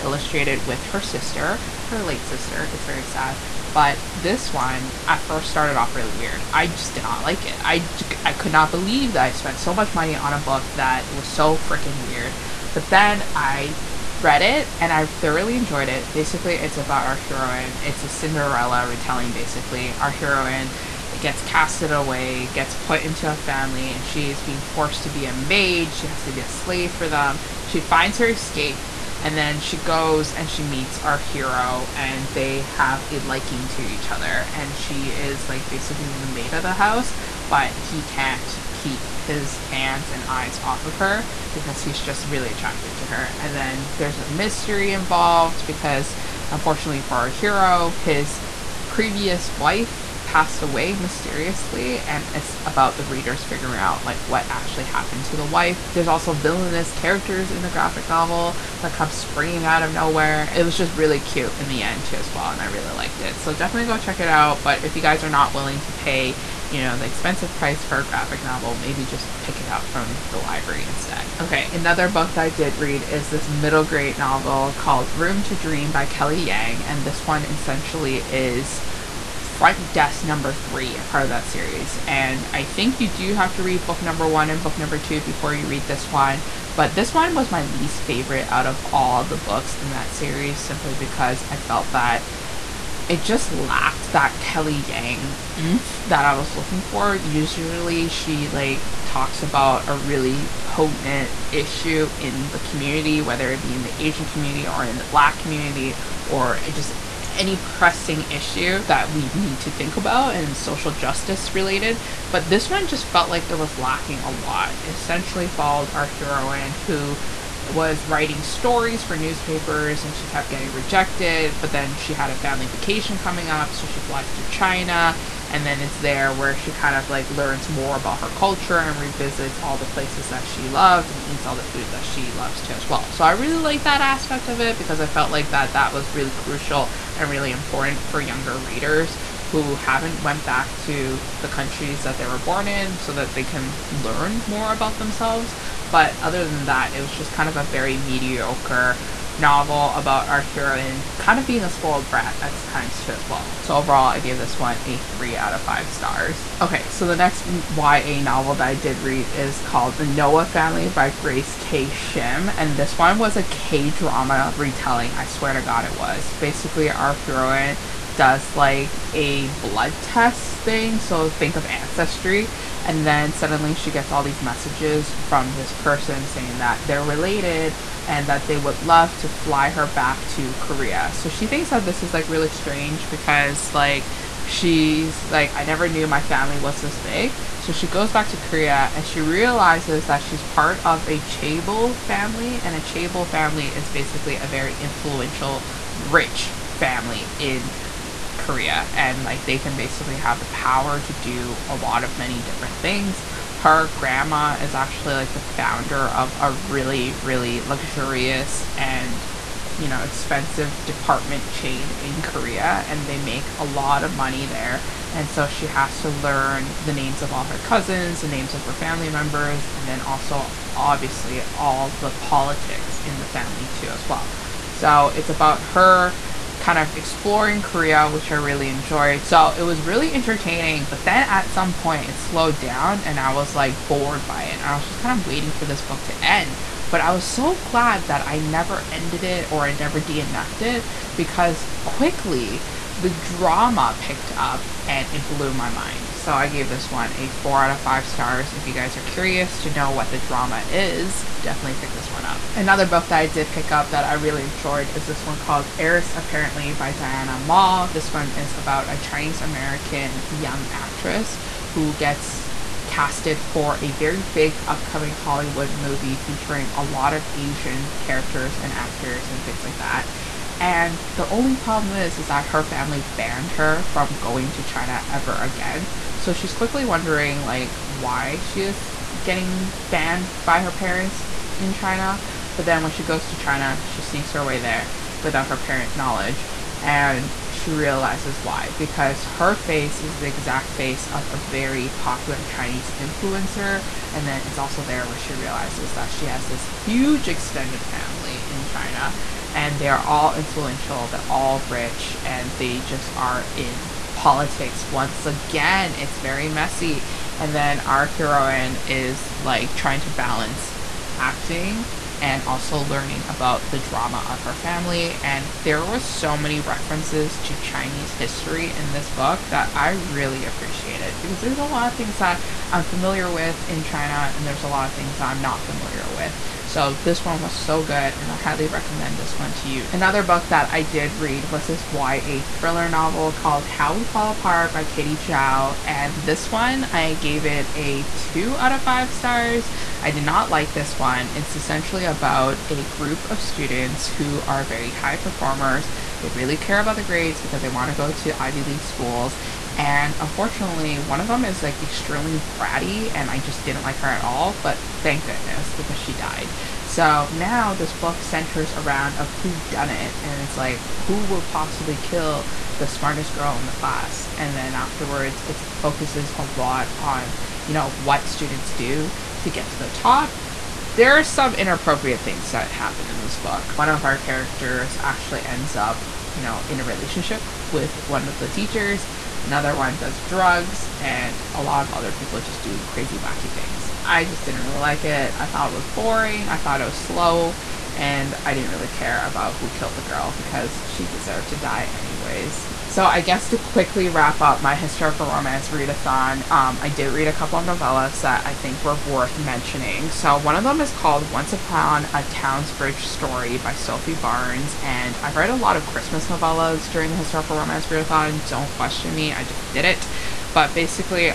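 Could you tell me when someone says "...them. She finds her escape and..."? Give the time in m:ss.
0:27.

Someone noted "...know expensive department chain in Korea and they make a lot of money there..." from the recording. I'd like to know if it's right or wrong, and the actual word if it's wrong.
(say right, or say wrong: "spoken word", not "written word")
right.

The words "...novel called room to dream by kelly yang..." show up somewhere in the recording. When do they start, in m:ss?
1:14.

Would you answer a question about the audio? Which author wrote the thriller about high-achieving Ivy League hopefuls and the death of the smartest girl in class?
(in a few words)
Katie Zhao.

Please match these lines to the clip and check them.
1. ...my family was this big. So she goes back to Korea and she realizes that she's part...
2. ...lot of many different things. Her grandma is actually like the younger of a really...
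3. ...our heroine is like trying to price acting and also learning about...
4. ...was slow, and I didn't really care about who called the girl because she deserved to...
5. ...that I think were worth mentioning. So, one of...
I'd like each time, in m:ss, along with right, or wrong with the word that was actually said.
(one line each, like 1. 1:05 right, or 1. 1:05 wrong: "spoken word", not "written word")
1. 3:06 right
2. 3:21 wrong: "founder", not "younger"
3. 5:07 wrong: "balance", not "price"
4. 6:26 wrong: "killed", not "called"
5. 6:38 right.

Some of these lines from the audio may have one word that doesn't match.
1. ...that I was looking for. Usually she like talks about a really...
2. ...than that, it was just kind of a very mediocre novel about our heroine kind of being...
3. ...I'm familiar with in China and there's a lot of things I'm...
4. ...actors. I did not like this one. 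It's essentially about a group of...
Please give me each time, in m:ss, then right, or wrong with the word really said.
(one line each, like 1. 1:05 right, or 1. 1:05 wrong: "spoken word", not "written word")
1. 1:36 right
2. 2:26 right
3. 5:22 right
4. 5:39 wrong: "stars", not "actors".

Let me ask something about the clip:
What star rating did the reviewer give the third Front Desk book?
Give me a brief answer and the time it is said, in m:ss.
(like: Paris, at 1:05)
3 out of 5, at 2:34.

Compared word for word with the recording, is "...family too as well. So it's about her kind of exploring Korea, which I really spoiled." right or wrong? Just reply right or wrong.
wrong.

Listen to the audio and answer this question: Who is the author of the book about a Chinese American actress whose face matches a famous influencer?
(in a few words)
Diana Ma.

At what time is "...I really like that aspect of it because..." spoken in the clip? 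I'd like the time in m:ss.
2:13.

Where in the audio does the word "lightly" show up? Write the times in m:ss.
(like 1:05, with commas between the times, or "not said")
not said.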